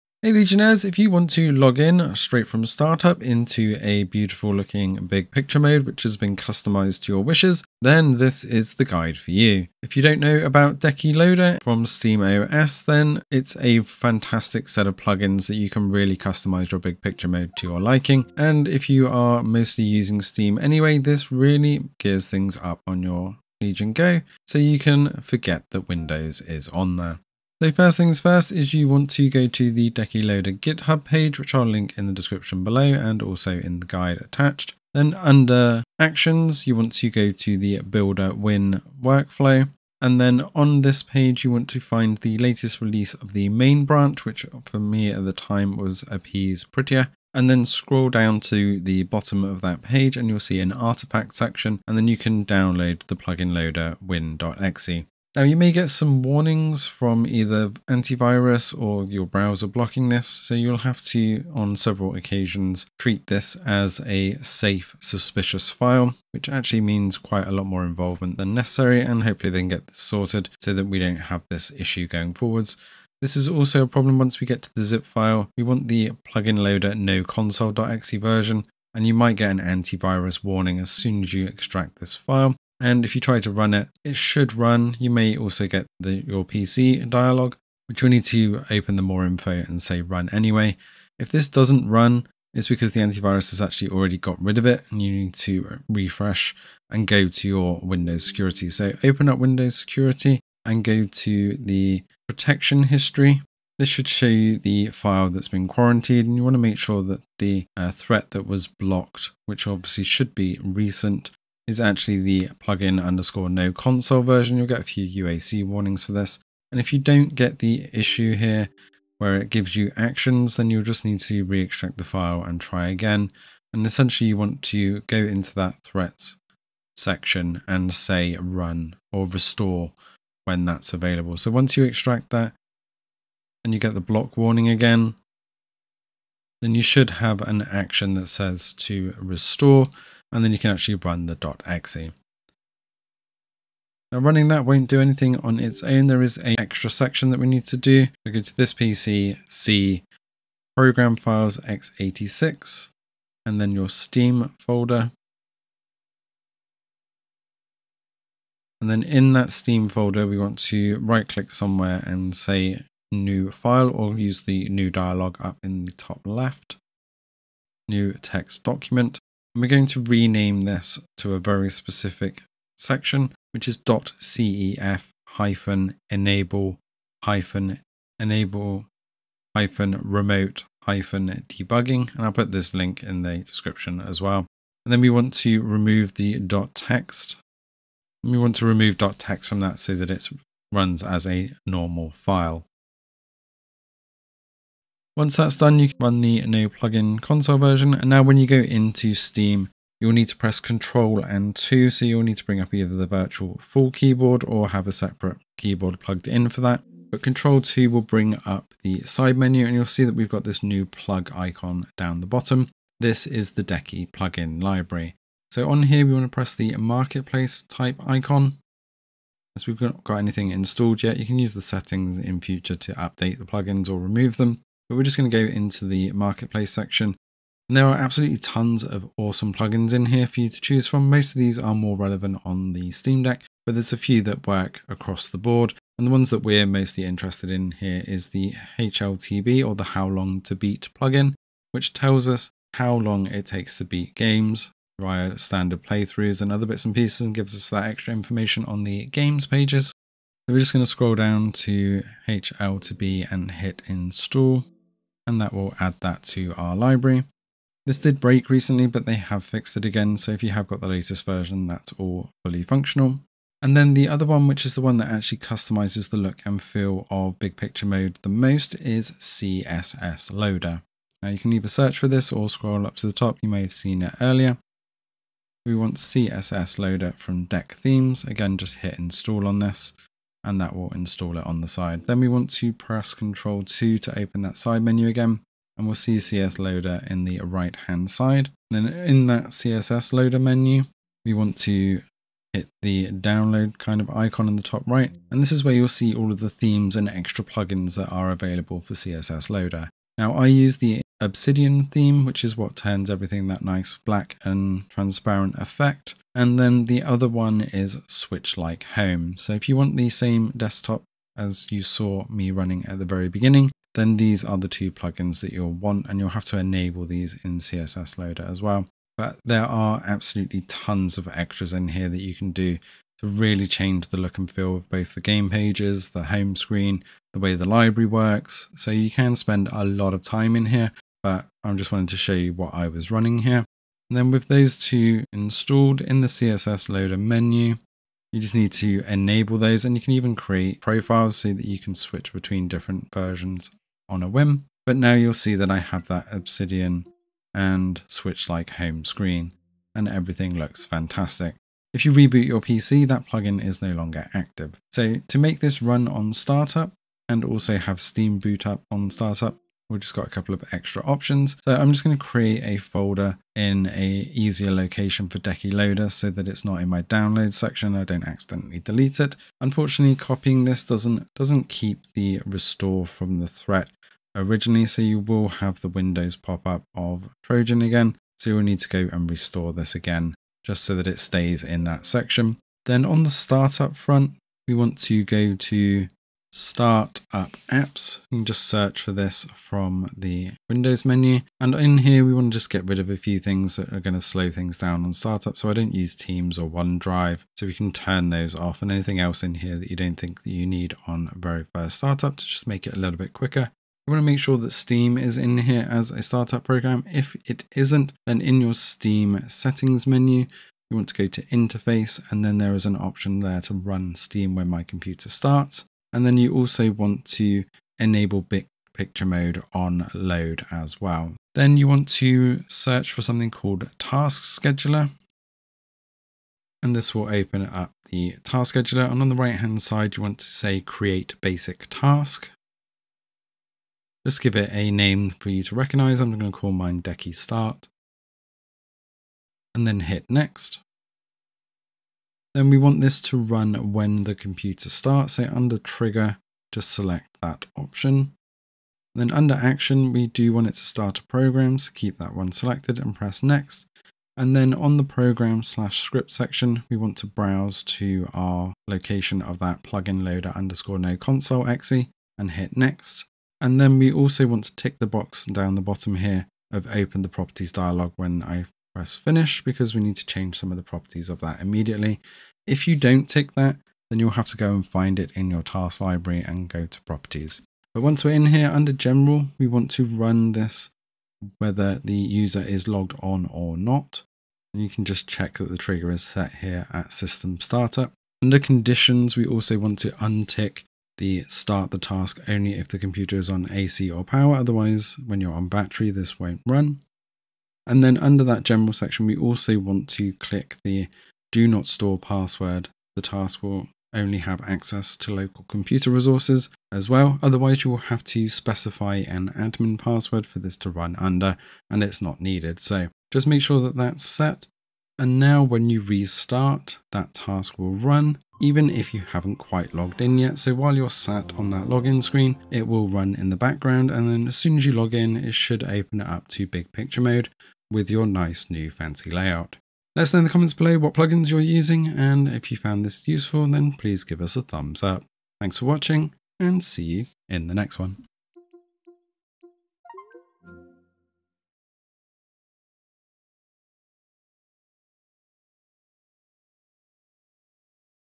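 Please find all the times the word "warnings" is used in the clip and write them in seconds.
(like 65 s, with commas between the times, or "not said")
56 s, 80 s, 115 s, 134 s.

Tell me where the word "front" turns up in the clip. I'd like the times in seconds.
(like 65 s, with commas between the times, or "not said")
383 s.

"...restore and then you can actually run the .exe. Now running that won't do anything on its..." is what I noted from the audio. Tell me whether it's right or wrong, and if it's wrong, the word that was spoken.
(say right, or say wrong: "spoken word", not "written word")
right.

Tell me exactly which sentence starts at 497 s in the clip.
And then under that general section, we also want to click the do not store password.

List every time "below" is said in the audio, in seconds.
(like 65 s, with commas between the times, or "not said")
32 s, 530 s.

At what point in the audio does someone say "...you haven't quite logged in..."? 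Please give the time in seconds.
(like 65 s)
519 s.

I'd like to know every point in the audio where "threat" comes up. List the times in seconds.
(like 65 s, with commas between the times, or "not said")
107 s, 125 s, 373 s.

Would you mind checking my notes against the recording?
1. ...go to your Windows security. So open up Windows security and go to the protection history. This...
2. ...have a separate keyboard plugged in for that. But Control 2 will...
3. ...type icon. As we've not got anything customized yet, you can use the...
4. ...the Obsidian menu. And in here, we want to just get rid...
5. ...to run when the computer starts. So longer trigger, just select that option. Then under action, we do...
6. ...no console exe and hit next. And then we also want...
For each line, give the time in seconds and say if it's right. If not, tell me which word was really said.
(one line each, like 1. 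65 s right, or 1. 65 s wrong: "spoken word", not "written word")
1. 97 s right
2. 204 s right
3. 217 s wrong: "installed", not "customized"
4. 390 s wrong: "Windows", not "Obsidian"
5. 443 s wrong: "under", not "longer"
6. 460 s right.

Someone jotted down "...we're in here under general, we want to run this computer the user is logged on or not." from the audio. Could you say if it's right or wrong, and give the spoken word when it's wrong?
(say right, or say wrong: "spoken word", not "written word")
wrong: "whether", not "computer".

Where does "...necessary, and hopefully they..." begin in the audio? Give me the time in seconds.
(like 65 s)
68 s.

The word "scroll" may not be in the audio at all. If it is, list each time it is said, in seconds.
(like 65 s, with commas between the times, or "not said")
47 s, 250 s, 272 s.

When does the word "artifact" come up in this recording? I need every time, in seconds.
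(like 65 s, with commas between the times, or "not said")
50 s.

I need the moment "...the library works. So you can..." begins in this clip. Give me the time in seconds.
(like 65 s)
327 s.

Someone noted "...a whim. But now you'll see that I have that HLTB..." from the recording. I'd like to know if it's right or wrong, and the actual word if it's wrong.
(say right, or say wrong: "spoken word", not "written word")
wrong: "Obsidian", not "HLTB".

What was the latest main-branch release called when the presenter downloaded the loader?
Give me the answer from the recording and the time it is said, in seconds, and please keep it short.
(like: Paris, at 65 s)
Appease Prettier, at 46 s.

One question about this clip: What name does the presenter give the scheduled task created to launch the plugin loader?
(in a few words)
Decky Start.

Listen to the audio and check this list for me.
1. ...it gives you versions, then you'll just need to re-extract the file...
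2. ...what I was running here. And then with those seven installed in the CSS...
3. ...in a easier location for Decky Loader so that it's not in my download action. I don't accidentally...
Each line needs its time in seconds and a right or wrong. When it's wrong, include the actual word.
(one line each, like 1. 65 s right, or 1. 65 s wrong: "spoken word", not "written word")
1. 119 s wrong: "actions", not "versions"
2. 332 s wrong: "two", not "seven"
3. 363 s wrong: "section", not "action".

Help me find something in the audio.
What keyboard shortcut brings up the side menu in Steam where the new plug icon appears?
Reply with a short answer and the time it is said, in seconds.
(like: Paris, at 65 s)
Control 2, at 200 s.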